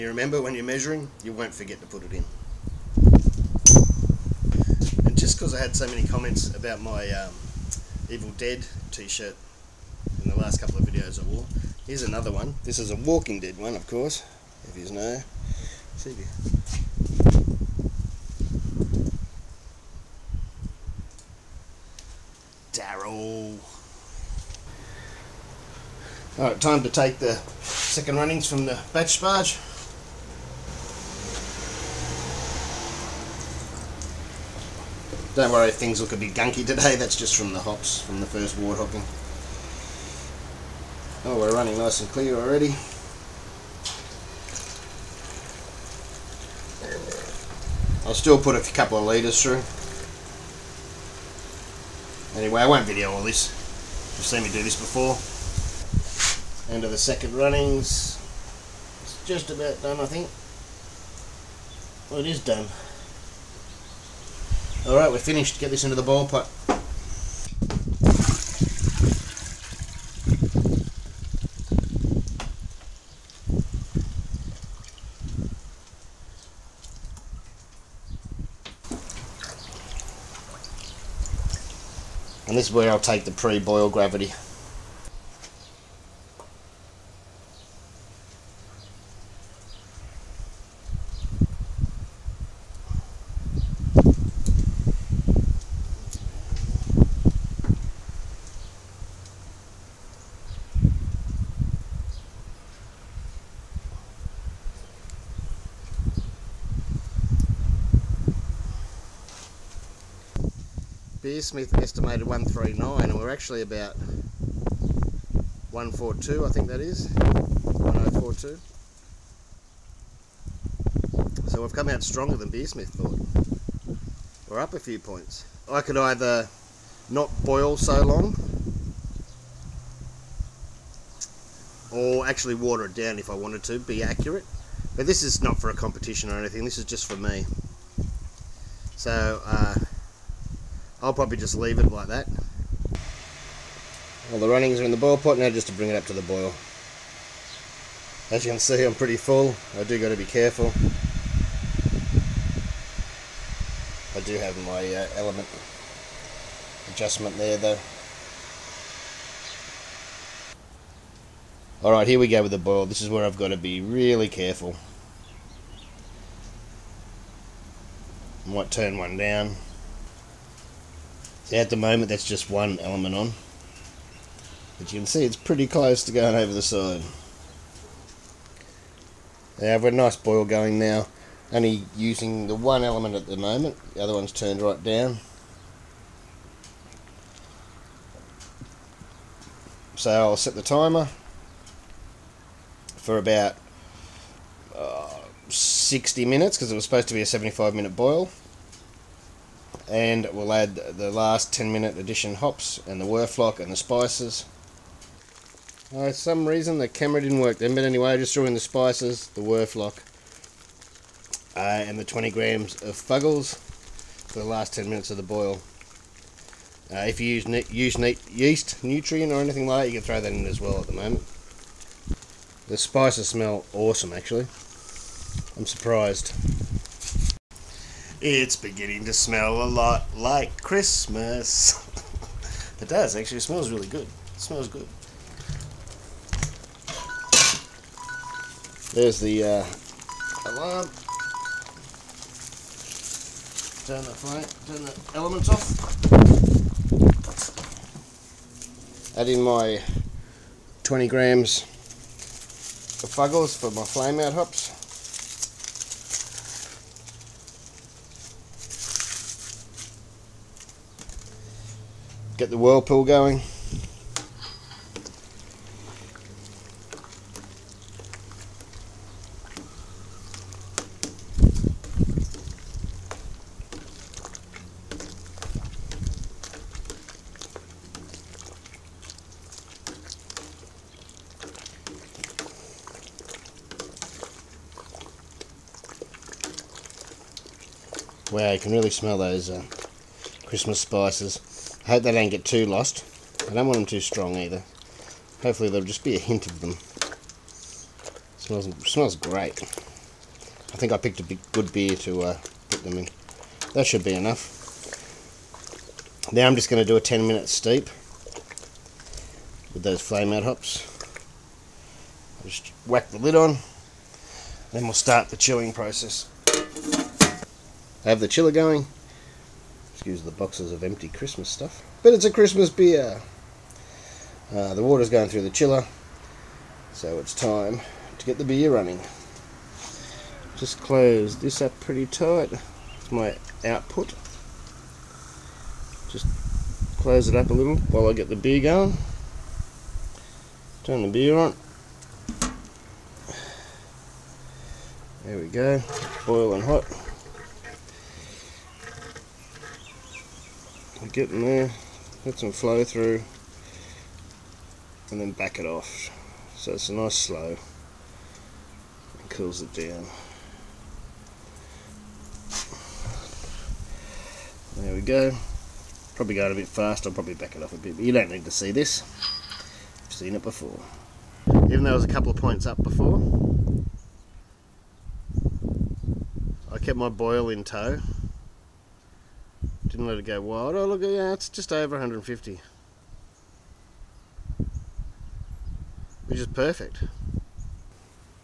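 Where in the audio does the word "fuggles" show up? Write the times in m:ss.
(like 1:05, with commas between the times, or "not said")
3:32, 4:13.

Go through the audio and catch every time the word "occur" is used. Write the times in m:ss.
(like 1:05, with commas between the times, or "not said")
not said.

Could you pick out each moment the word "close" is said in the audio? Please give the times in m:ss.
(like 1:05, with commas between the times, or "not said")
2:55, 5:30, 5:36.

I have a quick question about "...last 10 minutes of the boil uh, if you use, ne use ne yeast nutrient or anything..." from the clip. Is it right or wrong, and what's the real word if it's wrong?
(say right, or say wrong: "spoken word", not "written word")
right.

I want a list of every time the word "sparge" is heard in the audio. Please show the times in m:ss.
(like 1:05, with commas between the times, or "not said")
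0:29.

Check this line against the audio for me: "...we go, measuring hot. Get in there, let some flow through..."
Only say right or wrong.
wrong.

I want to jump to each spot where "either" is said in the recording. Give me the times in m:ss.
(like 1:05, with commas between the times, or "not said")
2:05, 4:54.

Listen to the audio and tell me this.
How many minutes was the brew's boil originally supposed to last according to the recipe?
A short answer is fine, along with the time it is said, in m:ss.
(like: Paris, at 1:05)
75 minutes, at 3:17.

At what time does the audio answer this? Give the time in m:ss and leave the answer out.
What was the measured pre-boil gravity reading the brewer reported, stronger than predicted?
1:57.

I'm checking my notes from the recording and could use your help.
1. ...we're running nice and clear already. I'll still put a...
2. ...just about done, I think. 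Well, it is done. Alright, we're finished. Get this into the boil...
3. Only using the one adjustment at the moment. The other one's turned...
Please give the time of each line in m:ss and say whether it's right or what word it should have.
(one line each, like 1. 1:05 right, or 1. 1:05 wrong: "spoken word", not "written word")
1. 0:41 right
2. 0:59 right
3. 3:01 wrong: "element", not "adjustment".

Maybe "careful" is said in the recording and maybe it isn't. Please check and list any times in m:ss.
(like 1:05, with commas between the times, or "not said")
2:30, 2:44.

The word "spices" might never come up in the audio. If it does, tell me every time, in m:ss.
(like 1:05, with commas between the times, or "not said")
3:23, 3:28, 3:42, 4:50.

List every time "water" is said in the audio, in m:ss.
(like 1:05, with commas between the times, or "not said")
2:12, 5:24.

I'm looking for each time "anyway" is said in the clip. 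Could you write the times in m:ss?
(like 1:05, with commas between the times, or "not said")
0:52, 3:27.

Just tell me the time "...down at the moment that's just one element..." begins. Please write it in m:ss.
2:49.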